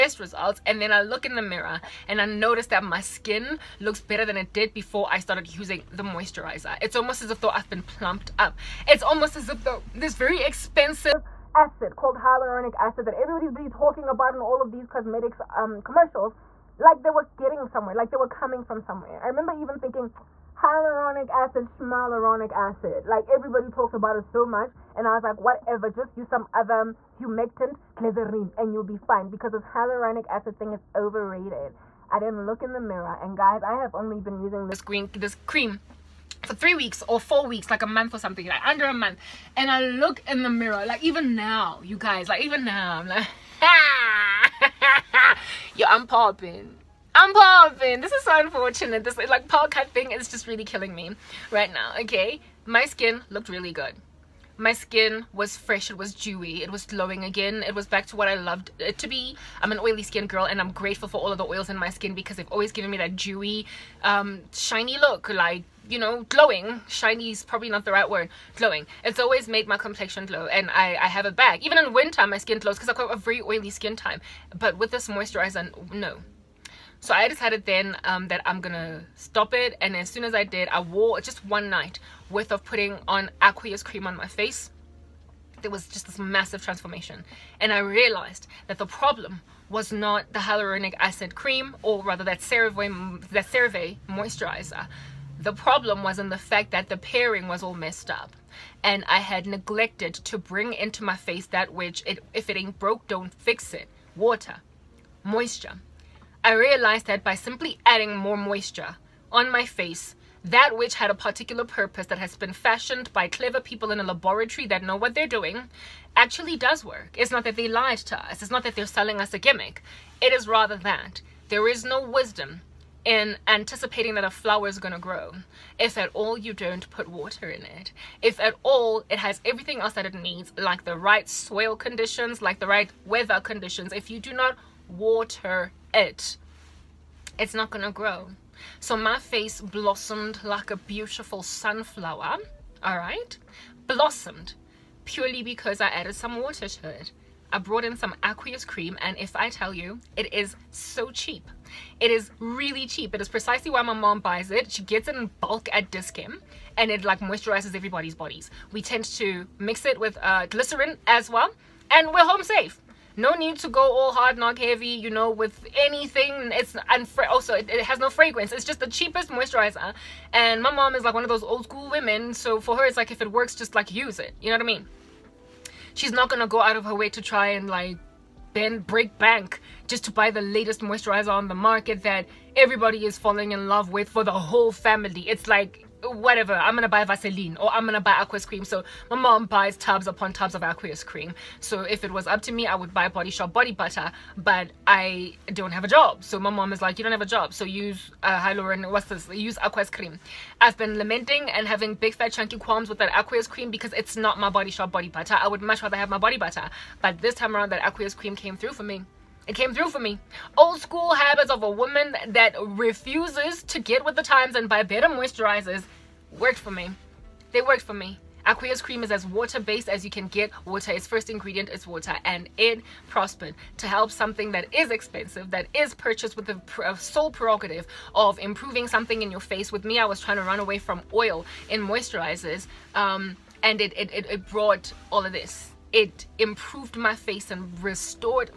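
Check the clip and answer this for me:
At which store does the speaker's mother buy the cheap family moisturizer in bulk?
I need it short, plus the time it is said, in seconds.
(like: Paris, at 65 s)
Dis-Chem, at 155 s.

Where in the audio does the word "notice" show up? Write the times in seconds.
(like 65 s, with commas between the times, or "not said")
2 s.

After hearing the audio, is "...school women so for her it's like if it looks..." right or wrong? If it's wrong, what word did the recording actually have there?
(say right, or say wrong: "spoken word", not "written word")
wrong: "works", not "looks".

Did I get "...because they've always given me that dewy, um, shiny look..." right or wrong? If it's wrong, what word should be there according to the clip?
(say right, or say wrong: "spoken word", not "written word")
right.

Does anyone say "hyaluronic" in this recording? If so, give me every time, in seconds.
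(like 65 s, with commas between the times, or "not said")
12 s, 20 s, 29 s, 90 s.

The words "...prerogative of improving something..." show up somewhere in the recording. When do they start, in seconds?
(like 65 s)
227 s.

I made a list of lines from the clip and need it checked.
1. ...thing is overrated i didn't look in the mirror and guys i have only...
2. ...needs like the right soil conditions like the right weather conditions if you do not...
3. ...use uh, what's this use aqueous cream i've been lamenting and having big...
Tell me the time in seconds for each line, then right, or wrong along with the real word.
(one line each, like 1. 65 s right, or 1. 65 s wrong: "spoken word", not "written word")
1. 30 s right
2. 130 s right
3. 197 s right.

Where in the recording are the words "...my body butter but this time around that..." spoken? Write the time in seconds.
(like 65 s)
206 s.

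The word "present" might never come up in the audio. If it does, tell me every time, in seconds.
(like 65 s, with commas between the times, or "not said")
not said.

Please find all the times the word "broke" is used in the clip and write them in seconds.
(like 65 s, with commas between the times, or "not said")
102 s.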